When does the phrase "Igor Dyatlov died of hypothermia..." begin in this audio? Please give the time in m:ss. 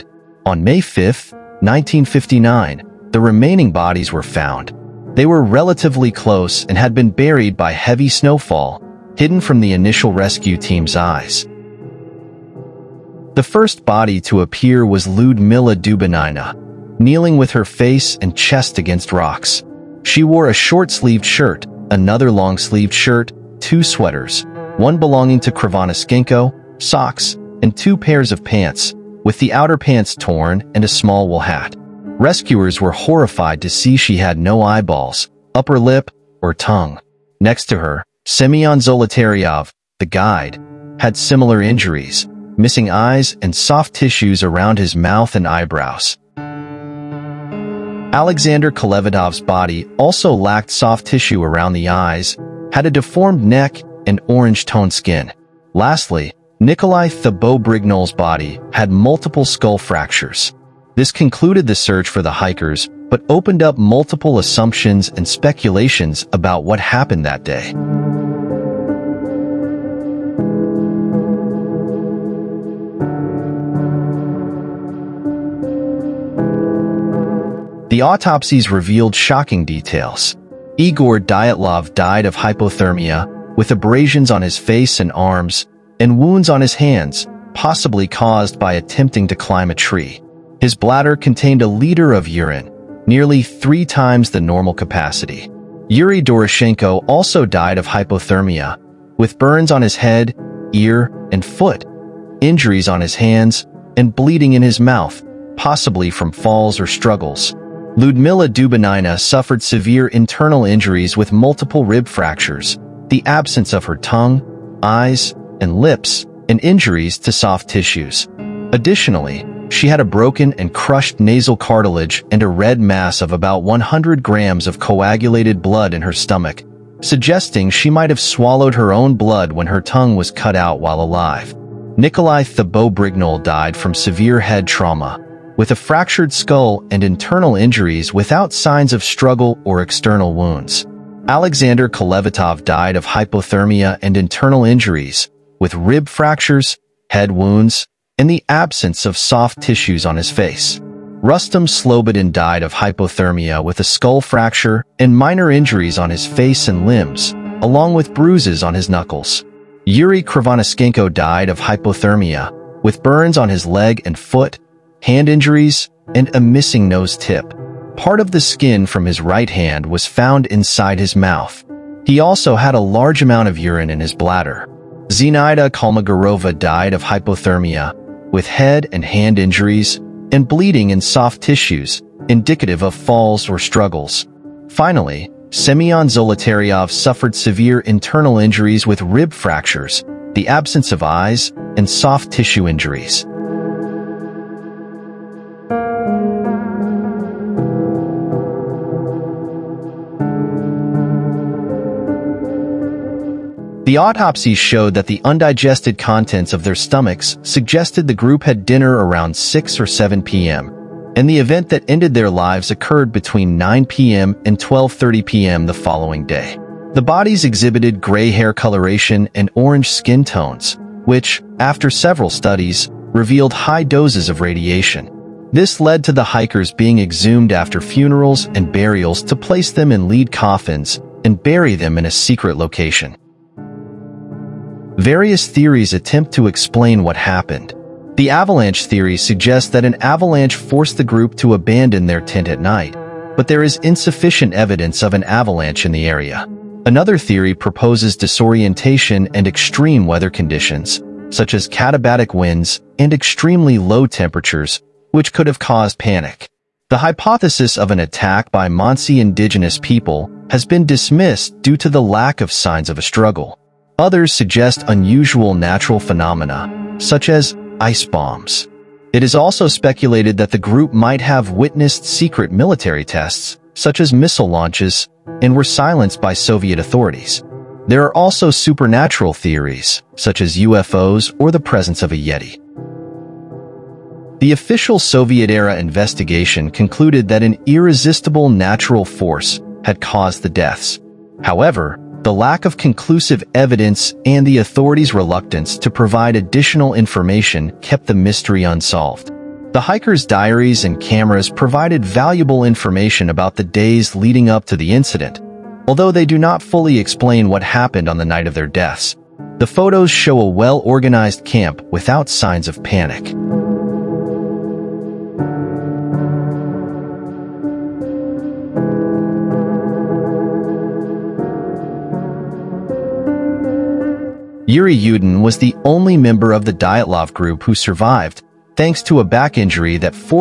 1:20.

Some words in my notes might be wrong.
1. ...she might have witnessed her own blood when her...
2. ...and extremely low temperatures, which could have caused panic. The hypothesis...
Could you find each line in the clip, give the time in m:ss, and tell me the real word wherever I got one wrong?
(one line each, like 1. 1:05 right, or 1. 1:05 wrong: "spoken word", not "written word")
1. 2:07 wrong: "swallowed", not "witnessed"
2. 4:12 right.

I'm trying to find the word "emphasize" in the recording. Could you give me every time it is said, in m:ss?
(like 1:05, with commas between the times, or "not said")
not said.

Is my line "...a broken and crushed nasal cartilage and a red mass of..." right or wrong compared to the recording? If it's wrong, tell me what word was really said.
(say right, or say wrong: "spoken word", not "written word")
right.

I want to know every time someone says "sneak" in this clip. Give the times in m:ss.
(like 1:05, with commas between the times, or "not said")
not said.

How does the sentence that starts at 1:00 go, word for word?
This concluded the search for the hikers, but opened up multiple assumptions and speculations about what happened that day.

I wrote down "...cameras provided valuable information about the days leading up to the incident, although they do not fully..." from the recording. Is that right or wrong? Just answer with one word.
right.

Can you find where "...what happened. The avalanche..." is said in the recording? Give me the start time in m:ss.
3:57.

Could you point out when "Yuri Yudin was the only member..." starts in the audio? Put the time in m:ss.
5:24.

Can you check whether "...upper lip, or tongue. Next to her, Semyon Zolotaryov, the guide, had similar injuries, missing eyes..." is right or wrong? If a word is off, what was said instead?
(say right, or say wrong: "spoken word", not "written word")
right.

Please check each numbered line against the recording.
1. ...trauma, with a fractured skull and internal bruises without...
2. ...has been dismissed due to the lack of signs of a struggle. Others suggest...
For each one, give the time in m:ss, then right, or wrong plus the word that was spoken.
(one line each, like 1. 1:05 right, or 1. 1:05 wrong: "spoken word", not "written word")
1. 2:14 wrong: "injuries", not "bruises"
2. 4:20 right.